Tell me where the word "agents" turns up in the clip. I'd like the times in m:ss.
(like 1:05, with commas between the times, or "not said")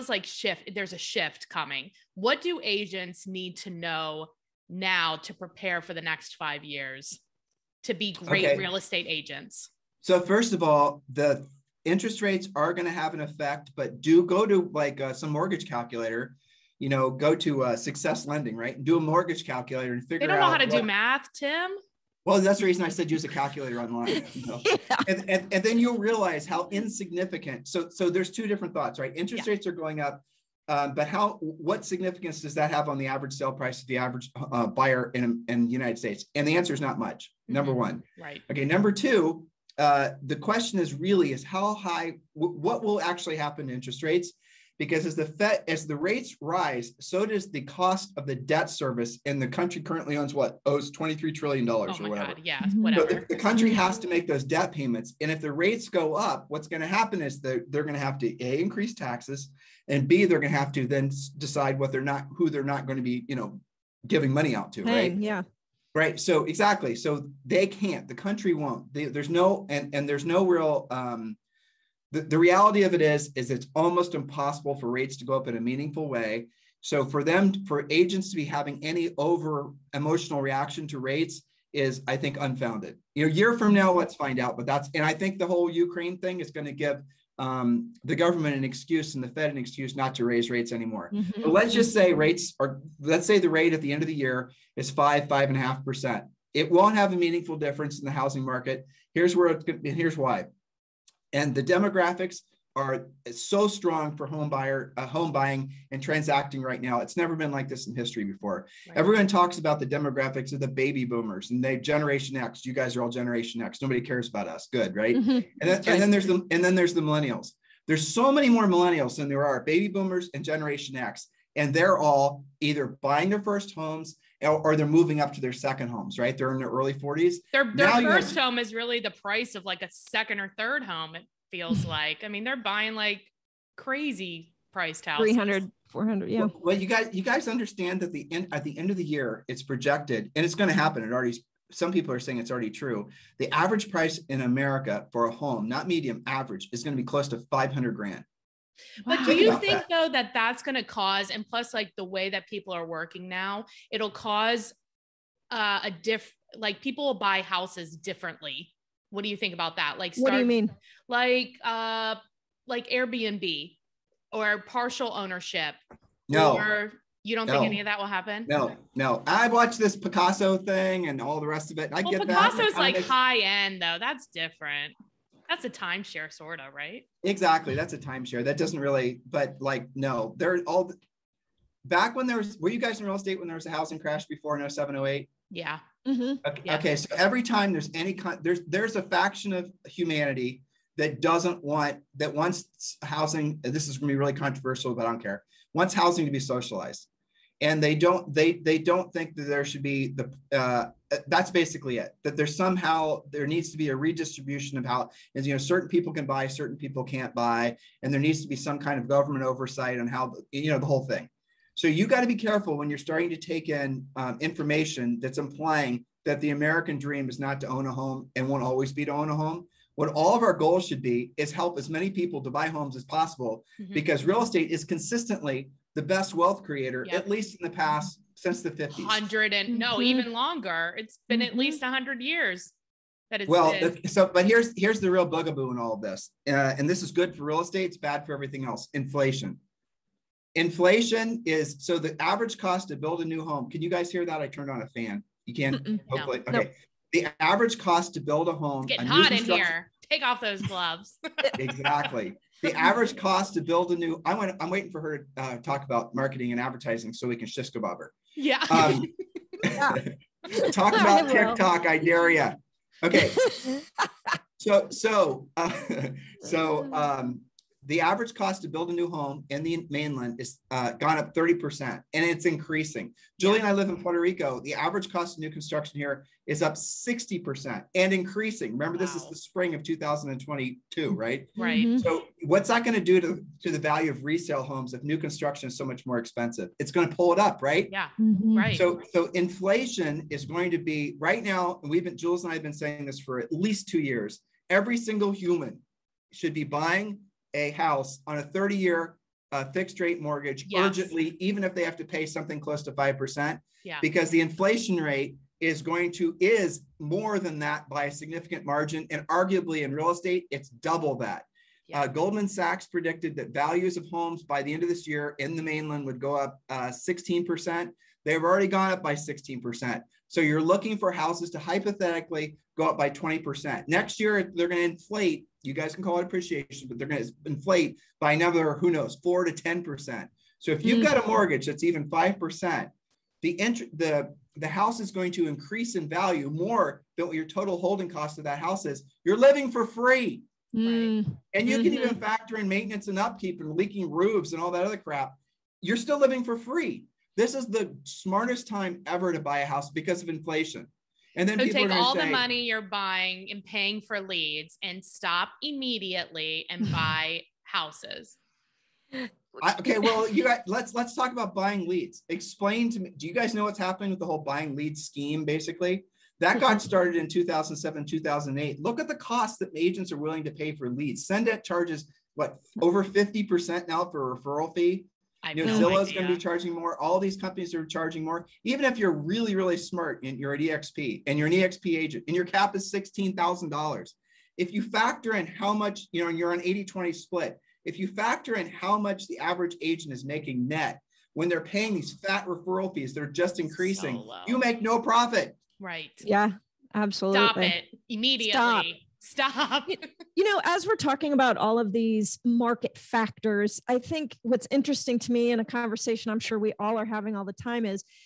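0:02, 0:09, 1:17, 6:09, 6:21, 6:29.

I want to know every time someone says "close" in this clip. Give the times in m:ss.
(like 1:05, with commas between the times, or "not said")
2:27, 5:02.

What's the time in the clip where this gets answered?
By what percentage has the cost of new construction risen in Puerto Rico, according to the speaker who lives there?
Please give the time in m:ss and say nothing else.
4:36.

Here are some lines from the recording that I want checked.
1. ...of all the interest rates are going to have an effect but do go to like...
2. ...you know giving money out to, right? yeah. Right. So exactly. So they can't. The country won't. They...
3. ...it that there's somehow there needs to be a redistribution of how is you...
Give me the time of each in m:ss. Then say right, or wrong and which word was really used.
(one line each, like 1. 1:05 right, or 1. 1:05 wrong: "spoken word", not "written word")
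1. 0:10 right
2. 1:03 right
3. 3:21 right.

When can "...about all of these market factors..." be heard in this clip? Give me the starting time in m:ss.
6:41.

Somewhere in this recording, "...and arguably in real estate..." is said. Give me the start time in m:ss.
5:09.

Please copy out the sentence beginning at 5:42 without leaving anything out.
factor in maintenance and upkeep and leaking roofs and all that other crap.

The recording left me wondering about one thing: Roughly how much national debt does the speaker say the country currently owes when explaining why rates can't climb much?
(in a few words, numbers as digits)
23 trillion dollars.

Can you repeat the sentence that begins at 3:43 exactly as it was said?
because real estate is consistently the best wealth creator, yep.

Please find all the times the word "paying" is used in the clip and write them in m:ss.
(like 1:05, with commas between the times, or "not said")
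5:53, 6:31.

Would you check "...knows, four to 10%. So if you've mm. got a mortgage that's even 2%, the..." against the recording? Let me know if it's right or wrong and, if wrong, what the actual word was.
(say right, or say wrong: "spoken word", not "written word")
wrong: "5", not "2".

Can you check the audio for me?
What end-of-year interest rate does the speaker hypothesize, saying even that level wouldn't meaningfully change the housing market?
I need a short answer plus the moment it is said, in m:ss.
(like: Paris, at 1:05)
5.5%, at 1:35.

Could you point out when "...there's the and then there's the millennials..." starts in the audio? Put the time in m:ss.
1:56.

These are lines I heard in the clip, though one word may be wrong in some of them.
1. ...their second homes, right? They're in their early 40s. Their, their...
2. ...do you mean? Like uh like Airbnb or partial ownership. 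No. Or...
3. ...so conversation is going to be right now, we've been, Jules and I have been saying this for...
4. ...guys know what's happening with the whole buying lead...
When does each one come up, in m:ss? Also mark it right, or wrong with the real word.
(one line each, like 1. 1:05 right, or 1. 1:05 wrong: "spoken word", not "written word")
1. 2:05 right
2. 2:40 right
3. 4:49 wrong: "inflation", not "conversation"
4. 6:03 right.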